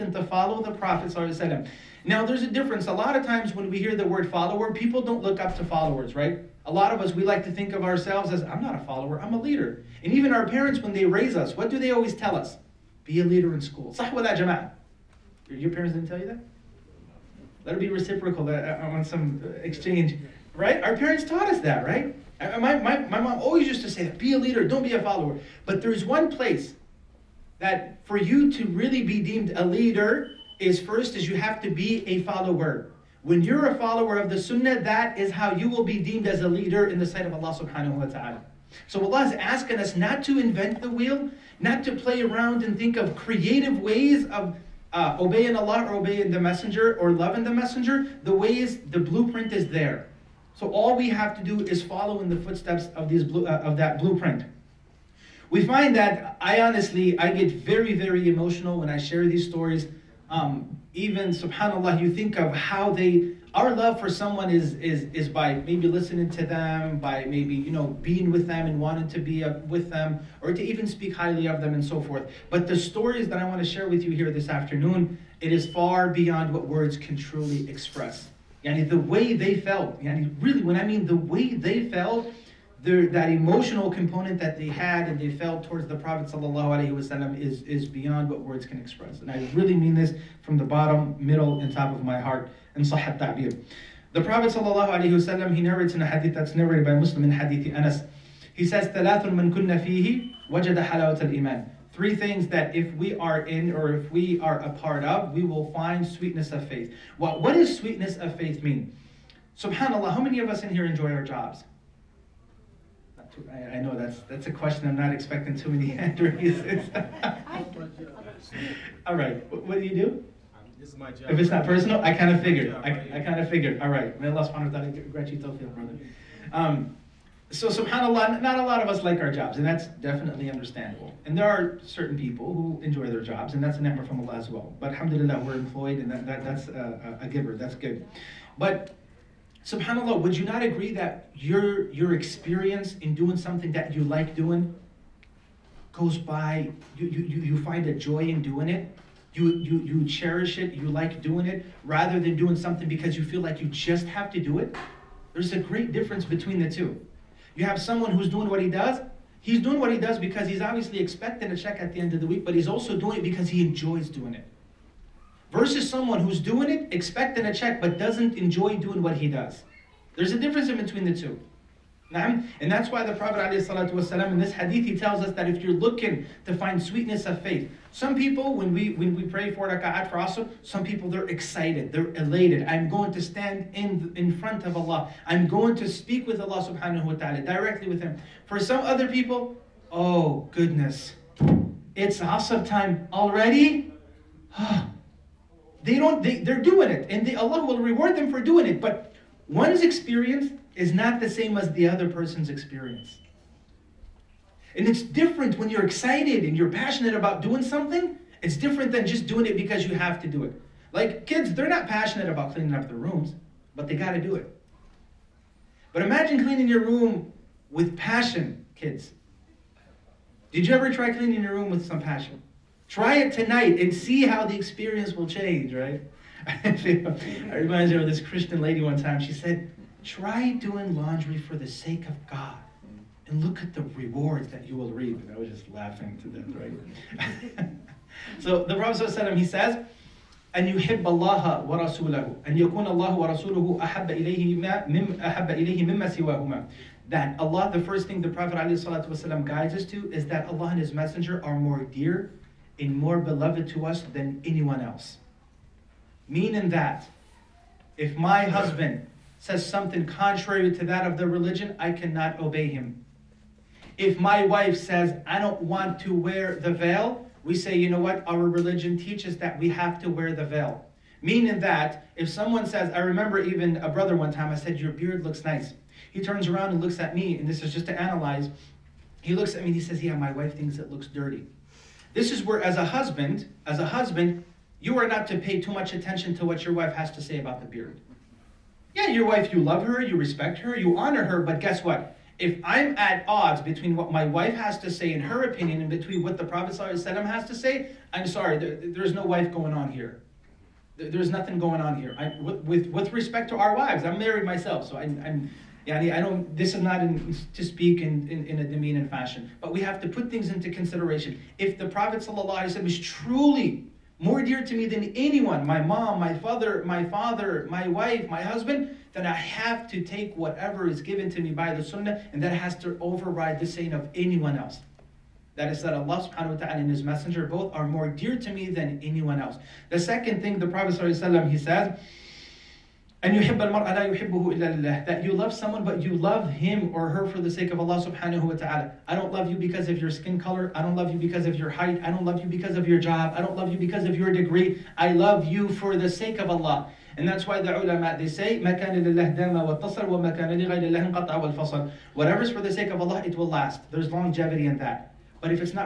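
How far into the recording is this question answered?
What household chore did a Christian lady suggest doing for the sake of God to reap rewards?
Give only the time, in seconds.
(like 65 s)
230 s.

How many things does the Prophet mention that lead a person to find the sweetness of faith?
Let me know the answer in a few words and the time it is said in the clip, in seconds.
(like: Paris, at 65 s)
3, at 101 s.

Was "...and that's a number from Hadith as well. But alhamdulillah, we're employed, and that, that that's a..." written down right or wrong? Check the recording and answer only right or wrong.
wrong.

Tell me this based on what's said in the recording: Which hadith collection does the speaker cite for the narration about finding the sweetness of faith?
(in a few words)
Muslim.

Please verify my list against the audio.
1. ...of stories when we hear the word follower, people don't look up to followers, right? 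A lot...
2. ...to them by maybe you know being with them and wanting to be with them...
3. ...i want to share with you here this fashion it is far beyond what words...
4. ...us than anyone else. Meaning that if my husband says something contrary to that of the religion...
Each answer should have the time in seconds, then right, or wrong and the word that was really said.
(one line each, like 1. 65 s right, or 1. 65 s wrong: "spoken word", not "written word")
1. 3 s wrong: "times", not "stories"
2. 66 s right
3. 73 s wrong: "afternoon", not "fashion"
4. 253 s right.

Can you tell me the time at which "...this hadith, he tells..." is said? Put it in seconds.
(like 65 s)
174 s.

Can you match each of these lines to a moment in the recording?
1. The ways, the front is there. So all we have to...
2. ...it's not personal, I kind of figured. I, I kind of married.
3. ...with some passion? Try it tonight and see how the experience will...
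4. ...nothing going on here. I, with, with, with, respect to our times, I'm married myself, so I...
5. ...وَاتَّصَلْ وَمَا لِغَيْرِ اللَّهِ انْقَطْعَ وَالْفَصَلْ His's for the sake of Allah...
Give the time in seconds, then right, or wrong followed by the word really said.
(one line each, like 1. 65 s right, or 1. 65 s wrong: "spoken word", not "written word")
1. 48 s wrong: "blueprint", not "front"
2. 121 s wrong: "figured", not "married"
3. 221 s right
4. 301 s wrong: "wives", not "times"
5. 349 s wrong: "Whatever", not "His".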